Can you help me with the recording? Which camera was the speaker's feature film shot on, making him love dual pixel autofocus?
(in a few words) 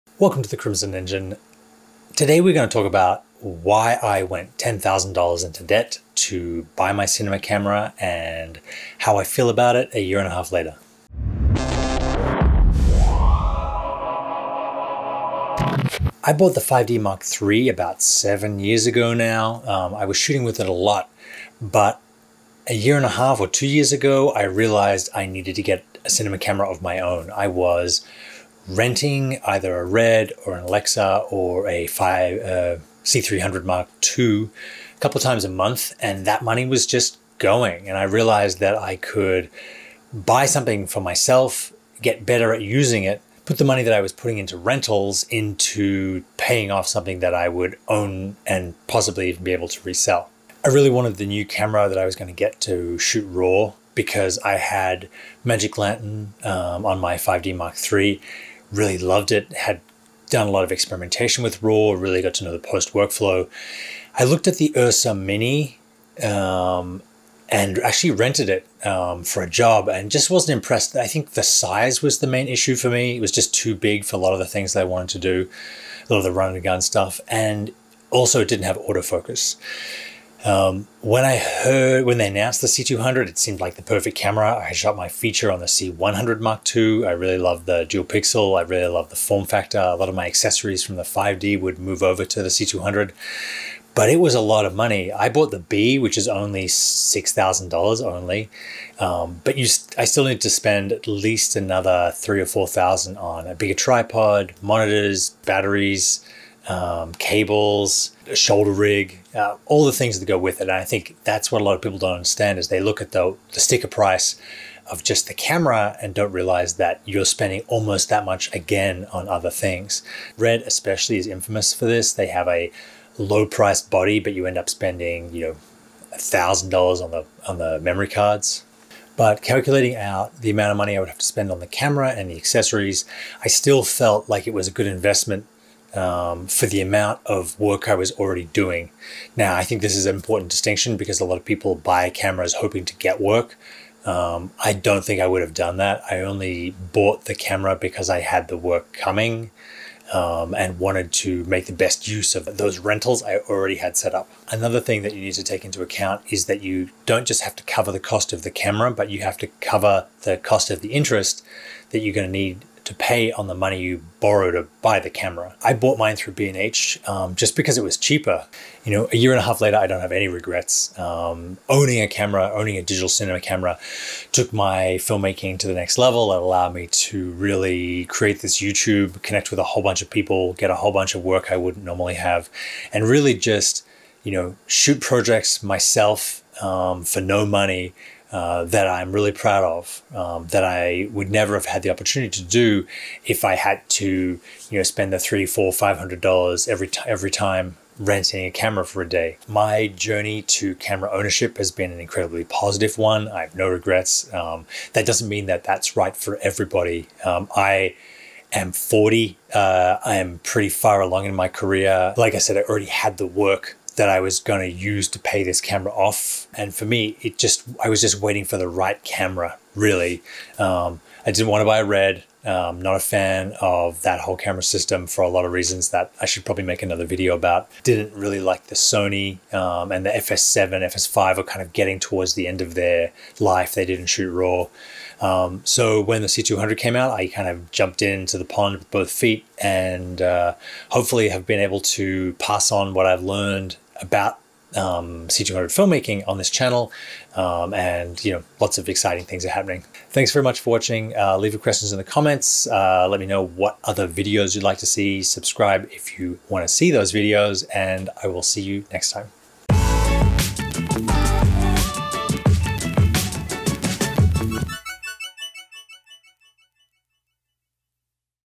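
C100 Mark II.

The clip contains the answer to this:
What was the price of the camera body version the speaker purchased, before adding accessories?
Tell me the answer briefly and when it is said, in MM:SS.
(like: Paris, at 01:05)
$6,000, at 01:36.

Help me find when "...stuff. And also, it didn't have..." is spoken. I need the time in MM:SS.
01:16.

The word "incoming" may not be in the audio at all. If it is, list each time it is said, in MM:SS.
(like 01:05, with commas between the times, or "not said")
not said.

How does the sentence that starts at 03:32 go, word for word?
Like I said, I already had the work that I was going to use to pay this camera off.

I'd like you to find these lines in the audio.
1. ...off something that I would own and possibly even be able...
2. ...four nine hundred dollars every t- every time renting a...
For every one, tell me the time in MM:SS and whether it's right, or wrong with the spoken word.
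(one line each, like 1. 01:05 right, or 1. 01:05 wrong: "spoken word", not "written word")
1. 00:46 right
2. 03:15 wrong: "five", not "nine".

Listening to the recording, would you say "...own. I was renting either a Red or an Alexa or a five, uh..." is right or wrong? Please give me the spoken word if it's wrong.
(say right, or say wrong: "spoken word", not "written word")
right.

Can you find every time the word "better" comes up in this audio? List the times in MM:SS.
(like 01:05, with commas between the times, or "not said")
00:42.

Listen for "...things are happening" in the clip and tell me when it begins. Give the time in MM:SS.
04:09.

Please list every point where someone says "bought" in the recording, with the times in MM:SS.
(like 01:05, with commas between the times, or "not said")
00:16, 01:35, 02:26, 02:45.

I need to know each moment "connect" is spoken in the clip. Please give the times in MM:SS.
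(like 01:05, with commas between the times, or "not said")
02:59.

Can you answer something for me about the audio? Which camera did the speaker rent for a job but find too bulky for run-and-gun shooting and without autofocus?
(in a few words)
Ursa Mini.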